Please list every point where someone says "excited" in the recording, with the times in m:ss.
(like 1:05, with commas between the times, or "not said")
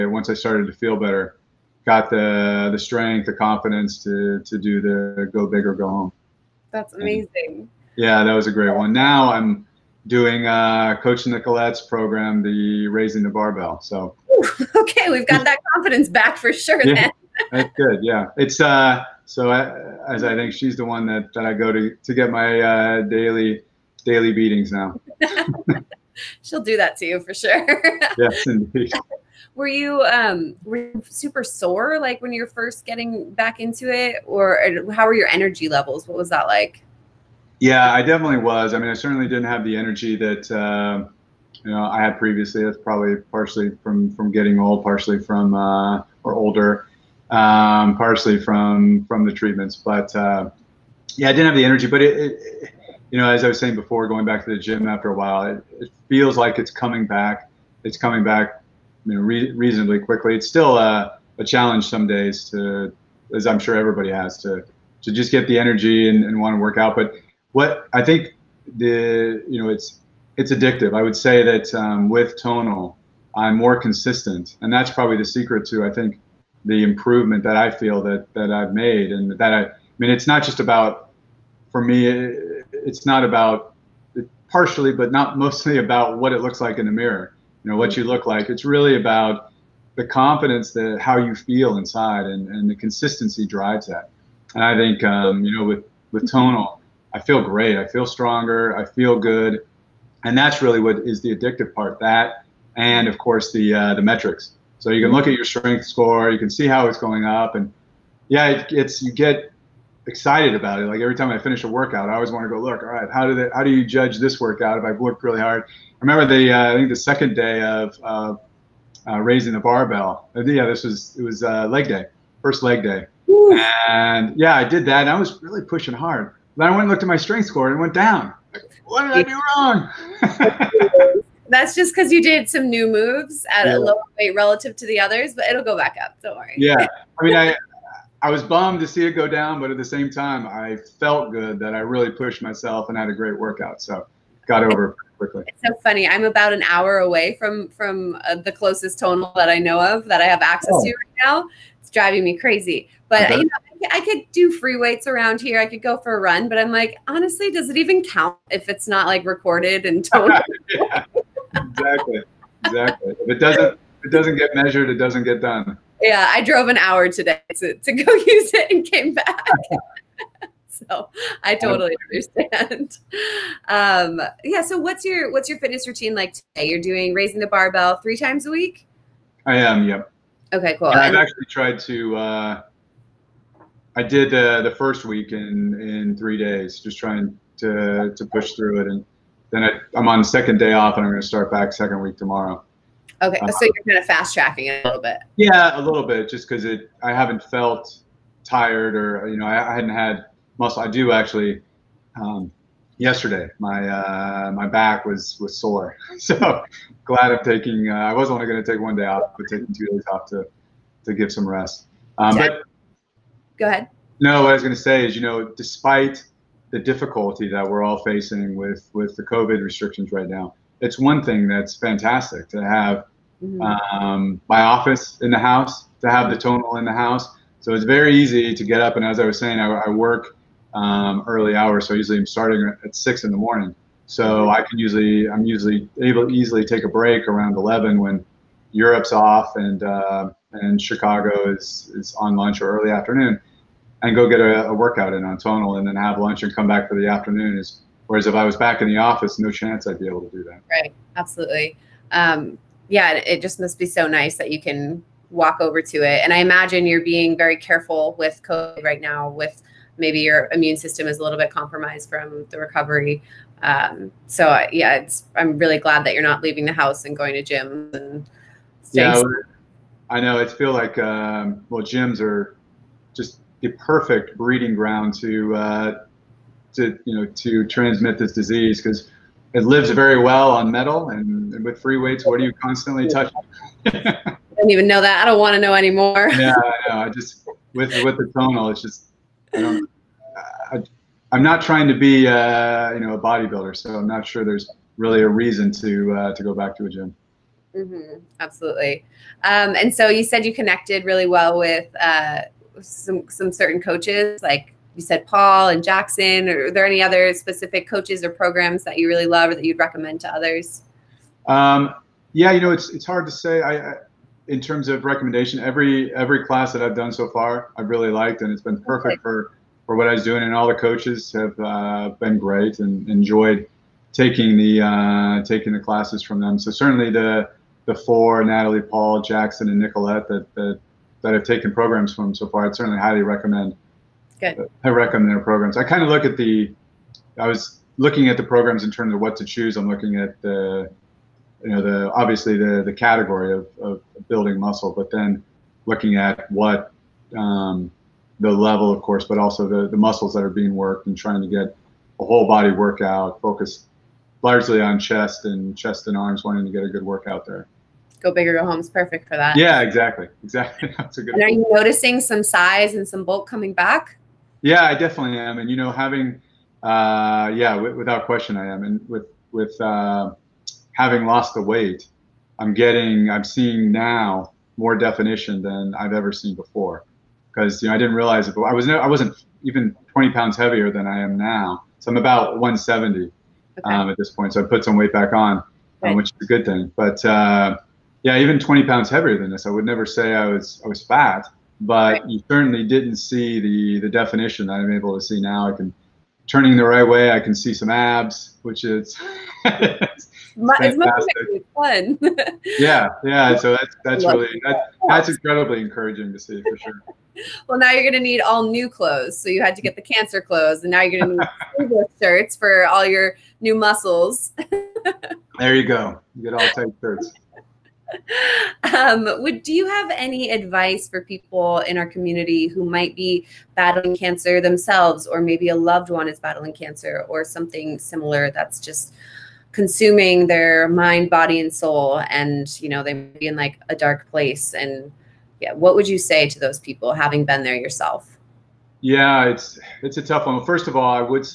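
1:50.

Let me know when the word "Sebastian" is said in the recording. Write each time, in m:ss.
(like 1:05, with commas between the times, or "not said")
not said.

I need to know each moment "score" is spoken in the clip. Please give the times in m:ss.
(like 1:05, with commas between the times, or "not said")
1:45, 2:07.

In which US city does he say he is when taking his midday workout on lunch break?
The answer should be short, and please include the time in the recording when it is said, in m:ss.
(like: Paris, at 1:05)
Chicago, at 4:00.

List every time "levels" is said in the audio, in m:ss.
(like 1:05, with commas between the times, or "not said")
0:35, 5:48.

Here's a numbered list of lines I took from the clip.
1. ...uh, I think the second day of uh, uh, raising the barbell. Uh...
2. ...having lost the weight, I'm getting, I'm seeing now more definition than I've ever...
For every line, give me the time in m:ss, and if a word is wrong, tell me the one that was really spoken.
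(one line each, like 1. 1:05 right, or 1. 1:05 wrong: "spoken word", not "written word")
1. 1:56 right
2. 6:10 right.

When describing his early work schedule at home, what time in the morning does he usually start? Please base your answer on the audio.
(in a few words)
6.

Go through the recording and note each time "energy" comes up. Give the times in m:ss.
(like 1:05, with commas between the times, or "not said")
0:35, 0:39, 0:51, 1:05.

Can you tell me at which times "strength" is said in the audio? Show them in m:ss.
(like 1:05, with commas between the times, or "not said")
0:02, 1:45, 2:07.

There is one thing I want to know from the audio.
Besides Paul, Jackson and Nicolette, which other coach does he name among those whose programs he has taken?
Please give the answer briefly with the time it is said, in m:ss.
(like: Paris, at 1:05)
Natalie, at 5:28.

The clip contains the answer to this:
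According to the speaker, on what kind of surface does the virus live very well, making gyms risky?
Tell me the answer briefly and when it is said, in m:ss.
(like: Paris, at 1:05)
metal, at 4:40.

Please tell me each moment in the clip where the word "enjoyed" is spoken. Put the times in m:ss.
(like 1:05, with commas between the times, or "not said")
5:23.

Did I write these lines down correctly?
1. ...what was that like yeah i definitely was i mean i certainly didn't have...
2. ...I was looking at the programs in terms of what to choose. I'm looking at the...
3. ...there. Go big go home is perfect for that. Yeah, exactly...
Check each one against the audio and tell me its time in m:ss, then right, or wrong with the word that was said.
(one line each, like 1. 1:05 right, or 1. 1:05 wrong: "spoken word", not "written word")
1. 0:36 right
2. 5:37 right
3. 5:57 right.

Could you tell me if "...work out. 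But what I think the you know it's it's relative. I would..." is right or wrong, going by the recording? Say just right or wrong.
wrong.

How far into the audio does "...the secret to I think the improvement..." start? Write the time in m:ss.
1:15.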